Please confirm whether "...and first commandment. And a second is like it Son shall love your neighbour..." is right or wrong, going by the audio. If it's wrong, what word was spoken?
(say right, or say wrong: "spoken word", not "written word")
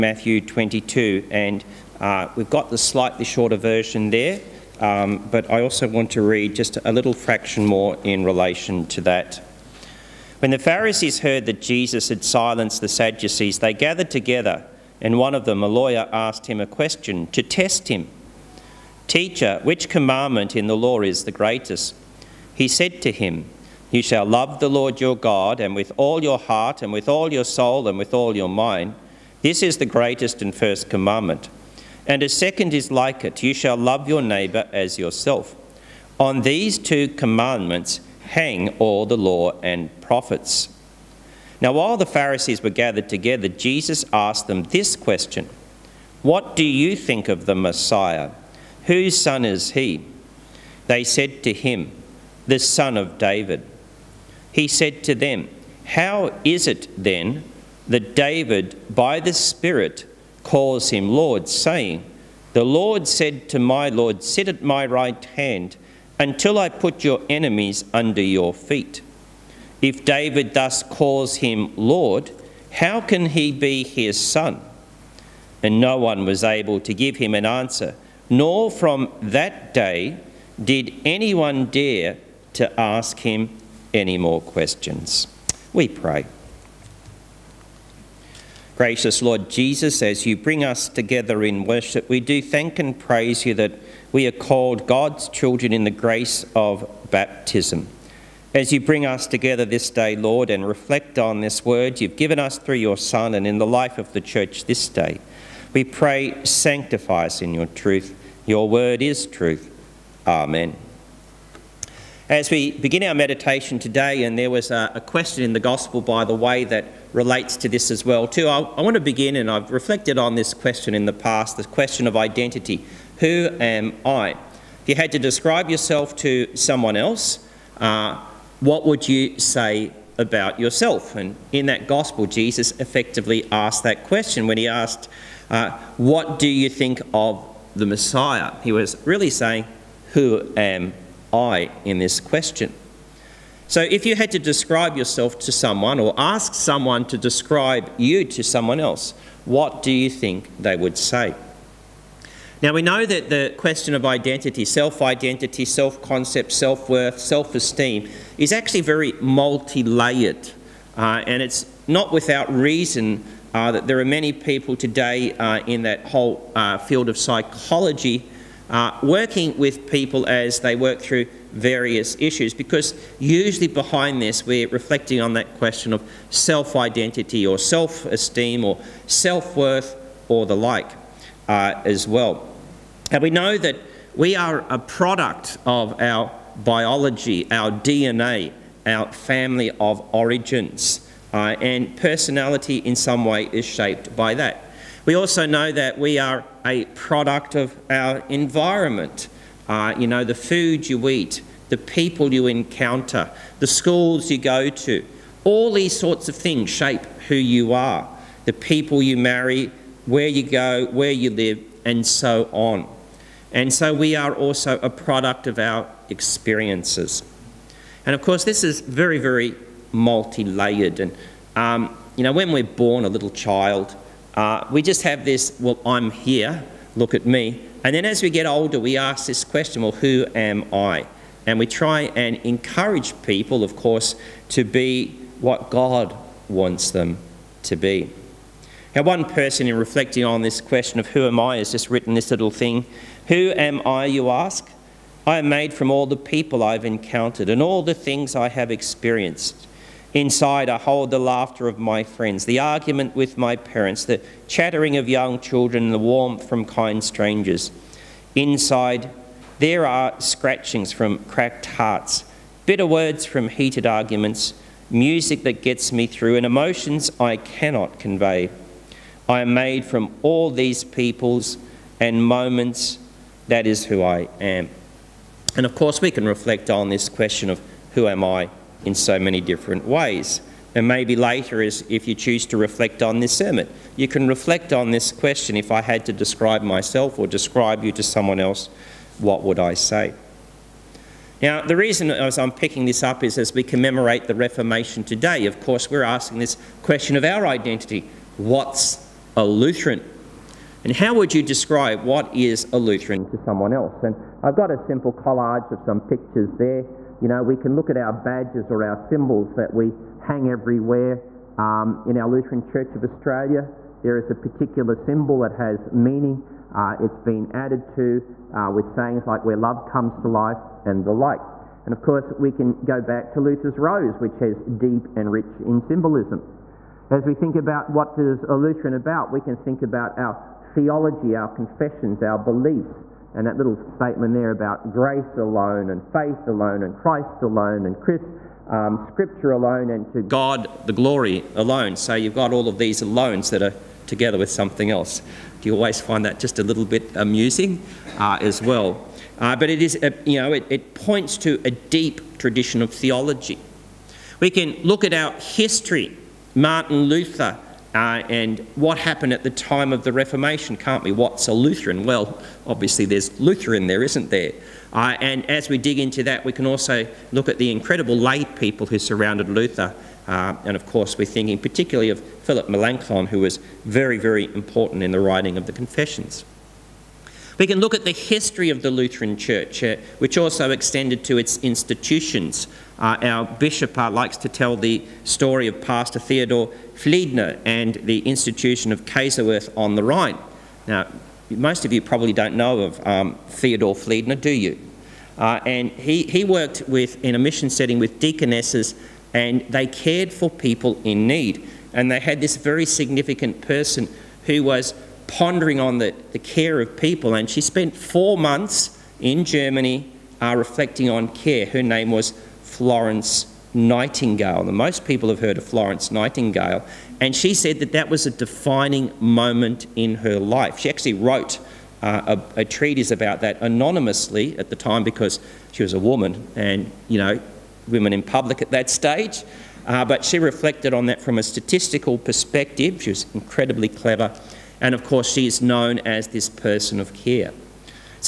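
wrong: "You", not "Son".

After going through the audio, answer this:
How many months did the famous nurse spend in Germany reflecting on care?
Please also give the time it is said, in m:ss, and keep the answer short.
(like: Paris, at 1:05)
4, at 6:47.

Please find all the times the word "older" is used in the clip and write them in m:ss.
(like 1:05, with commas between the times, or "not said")
3:48.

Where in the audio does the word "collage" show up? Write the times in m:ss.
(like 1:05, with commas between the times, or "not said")
5:05.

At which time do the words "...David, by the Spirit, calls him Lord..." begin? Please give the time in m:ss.
0:58.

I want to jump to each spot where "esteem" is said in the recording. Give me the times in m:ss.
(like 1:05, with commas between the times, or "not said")
2:37, 2:58.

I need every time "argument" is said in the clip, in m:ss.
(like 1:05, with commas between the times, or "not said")
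4:12, 4:23.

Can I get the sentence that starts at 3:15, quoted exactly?
We also know that we are a product of our environment.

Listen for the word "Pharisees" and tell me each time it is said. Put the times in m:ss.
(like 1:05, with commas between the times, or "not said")
0:10, 0:42.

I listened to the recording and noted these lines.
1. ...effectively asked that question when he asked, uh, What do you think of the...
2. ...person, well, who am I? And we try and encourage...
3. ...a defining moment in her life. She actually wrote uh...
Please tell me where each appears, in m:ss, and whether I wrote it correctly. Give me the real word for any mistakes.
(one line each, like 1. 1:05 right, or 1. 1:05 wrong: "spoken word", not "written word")
1. 2:12 right
2. 3:49 wrong: "question", not "person"
3. 6:58 right.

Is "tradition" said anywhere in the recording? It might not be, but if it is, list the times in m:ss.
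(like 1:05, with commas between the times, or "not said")
5:52.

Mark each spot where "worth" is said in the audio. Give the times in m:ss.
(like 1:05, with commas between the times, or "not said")
2:36, 2:59.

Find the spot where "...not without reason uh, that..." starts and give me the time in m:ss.
2:41.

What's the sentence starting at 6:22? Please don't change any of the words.
Uh, our bishop uh, likes to tell the story of Pastor Theodore Fliedner and the institution of Kaiserswerth on the Rhine.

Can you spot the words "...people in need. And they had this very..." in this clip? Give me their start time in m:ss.
6:40.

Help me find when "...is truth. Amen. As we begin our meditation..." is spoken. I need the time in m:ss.
1:49.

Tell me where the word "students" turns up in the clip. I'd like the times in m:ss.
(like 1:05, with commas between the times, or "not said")
not said.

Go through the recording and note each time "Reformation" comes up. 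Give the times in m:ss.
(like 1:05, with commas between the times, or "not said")
4:54, 6:00.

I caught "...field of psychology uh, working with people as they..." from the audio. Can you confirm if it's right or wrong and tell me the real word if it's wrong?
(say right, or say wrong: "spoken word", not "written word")
right.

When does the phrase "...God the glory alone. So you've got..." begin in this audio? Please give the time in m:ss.
5:40.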